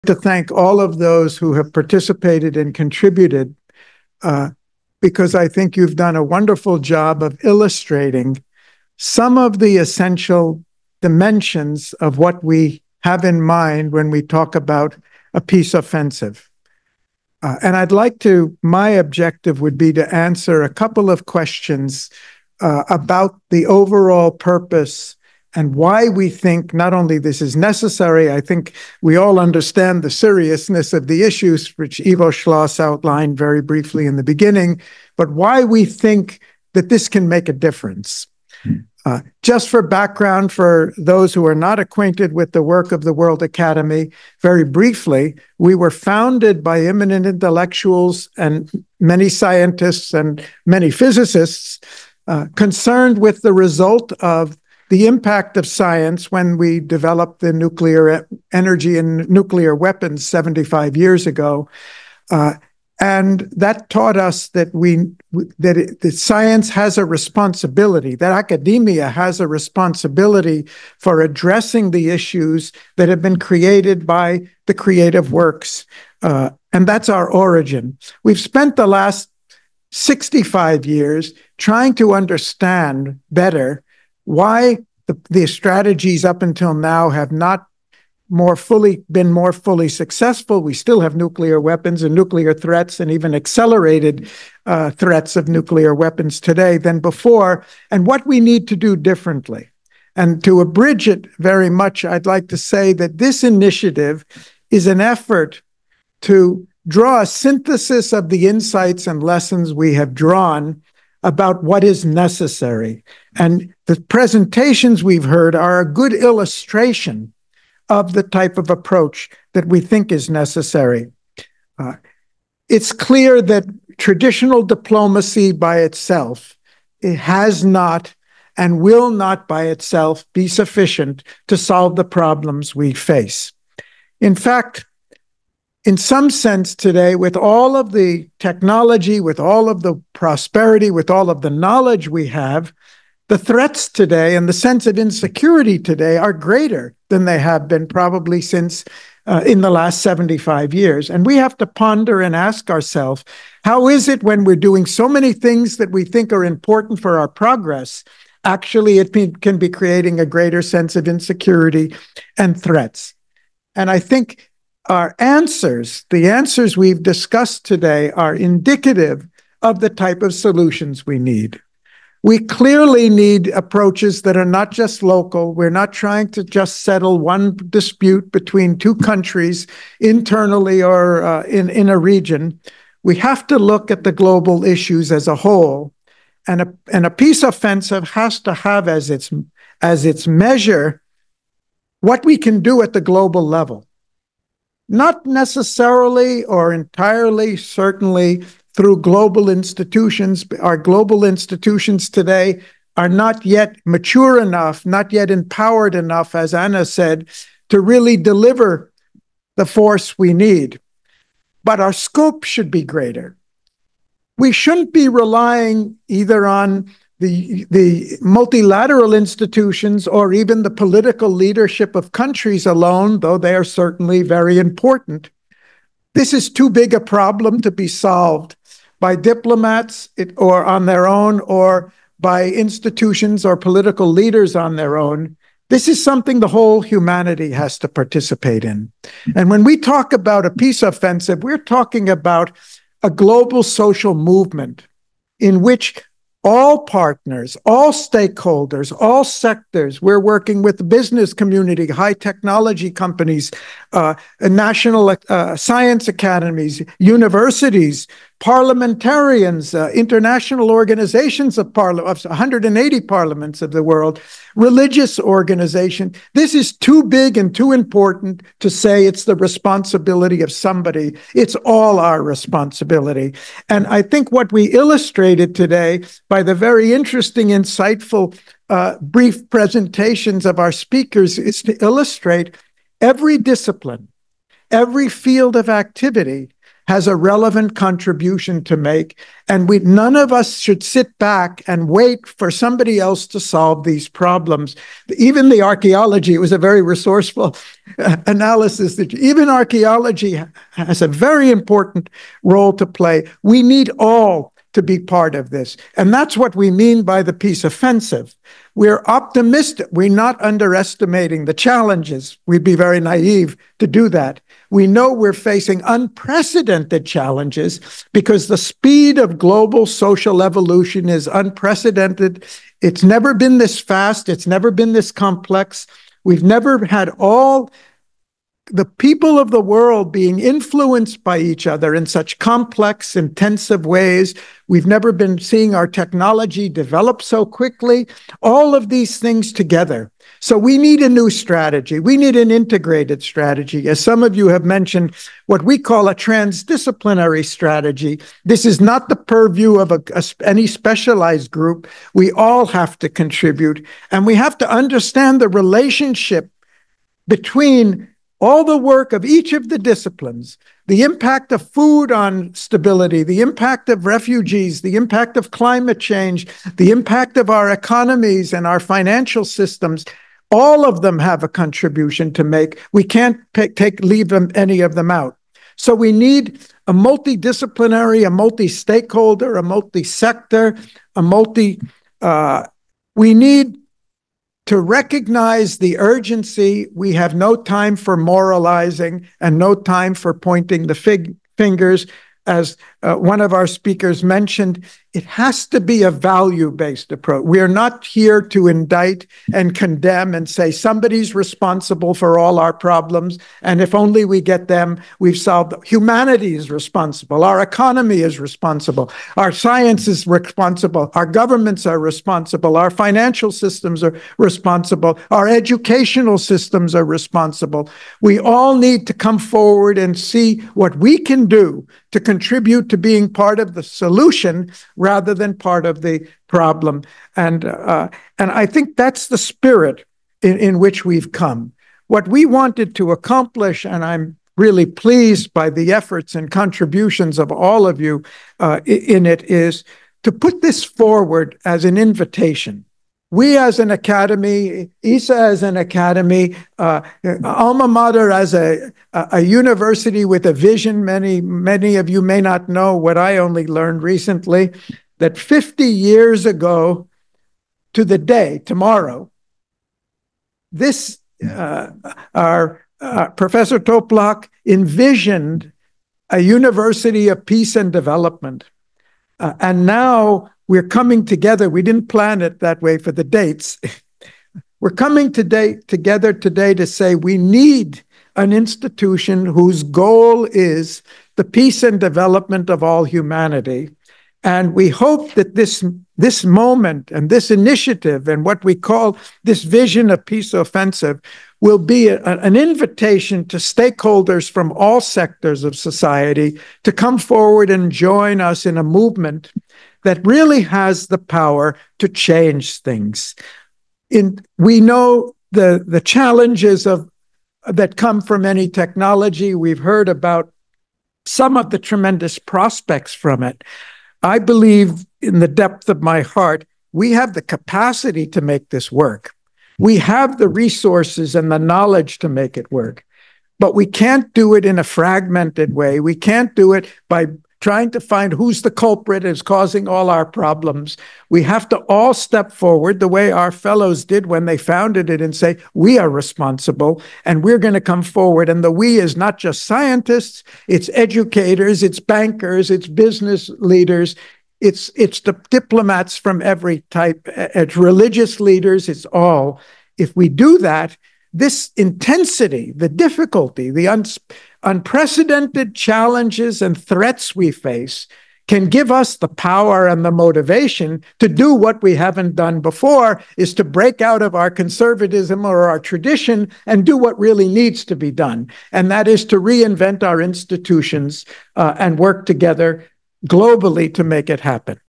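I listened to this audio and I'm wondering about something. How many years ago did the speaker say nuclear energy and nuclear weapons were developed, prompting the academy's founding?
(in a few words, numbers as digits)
75.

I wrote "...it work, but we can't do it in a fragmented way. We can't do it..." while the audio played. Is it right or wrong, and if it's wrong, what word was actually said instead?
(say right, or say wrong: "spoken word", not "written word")
right.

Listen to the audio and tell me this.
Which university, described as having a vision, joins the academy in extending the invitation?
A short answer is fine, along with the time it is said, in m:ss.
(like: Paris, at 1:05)
Alma Mater, at 7:27.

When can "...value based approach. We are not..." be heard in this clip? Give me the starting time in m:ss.
6:36.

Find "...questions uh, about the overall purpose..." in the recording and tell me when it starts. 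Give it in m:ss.
0:21.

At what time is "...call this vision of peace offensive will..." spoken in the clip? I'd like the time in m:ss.
8:08.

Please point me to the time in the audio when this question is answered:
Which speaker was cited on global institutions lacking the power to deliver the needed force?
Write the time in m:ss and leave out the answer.
3:26.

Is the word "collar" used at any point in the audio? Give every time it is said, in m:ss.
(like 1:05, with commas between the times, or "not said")
not said.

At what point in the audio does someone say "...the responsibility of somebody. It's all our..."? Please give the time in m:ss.
4:29.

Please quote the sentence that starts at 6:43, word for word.
And if only we get them, we've solved.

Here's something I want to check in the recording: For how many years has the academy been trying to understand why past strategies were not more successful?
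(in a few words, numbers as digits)
65.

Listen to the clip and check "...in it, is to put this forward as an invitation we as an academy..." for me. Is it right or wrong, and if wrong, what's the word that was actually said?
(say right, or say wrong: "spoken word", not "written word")
right.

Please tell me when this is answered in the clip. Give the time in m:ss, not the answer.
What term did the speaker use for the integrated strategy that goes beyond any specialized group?
5:46.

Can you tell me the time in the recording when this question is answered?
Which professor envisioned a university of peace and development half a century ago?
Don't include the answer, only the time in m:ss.
7:43.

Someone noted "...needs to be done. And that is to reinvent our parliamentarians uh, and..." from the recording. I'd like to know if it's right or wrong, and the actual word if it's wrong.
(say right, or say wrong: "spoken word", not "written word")
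wrong: "institutions", not "parliamentarians".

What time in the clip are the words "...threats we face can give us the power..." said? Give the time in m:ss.
9:16.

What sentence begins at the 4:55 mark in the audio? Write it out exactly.
Even the archaeology, it was a very resourceful uh, analysis that even archaeology has a very important role to play.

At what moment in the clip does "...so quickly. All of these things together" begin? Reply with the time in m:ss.
5:37.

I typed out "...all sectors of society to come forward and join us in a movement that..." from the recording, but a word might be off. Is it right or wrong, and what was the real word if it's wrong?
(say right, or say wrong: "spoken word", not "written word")
right.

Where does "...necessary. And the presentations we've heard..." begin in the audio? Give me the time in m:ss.
1:52.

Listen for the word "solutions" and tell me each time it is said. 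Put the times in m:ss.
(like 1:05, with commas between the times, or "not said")
2:50, 7:03.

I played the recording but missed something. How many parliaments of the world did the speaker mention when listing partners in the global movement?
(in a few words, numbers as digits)
180.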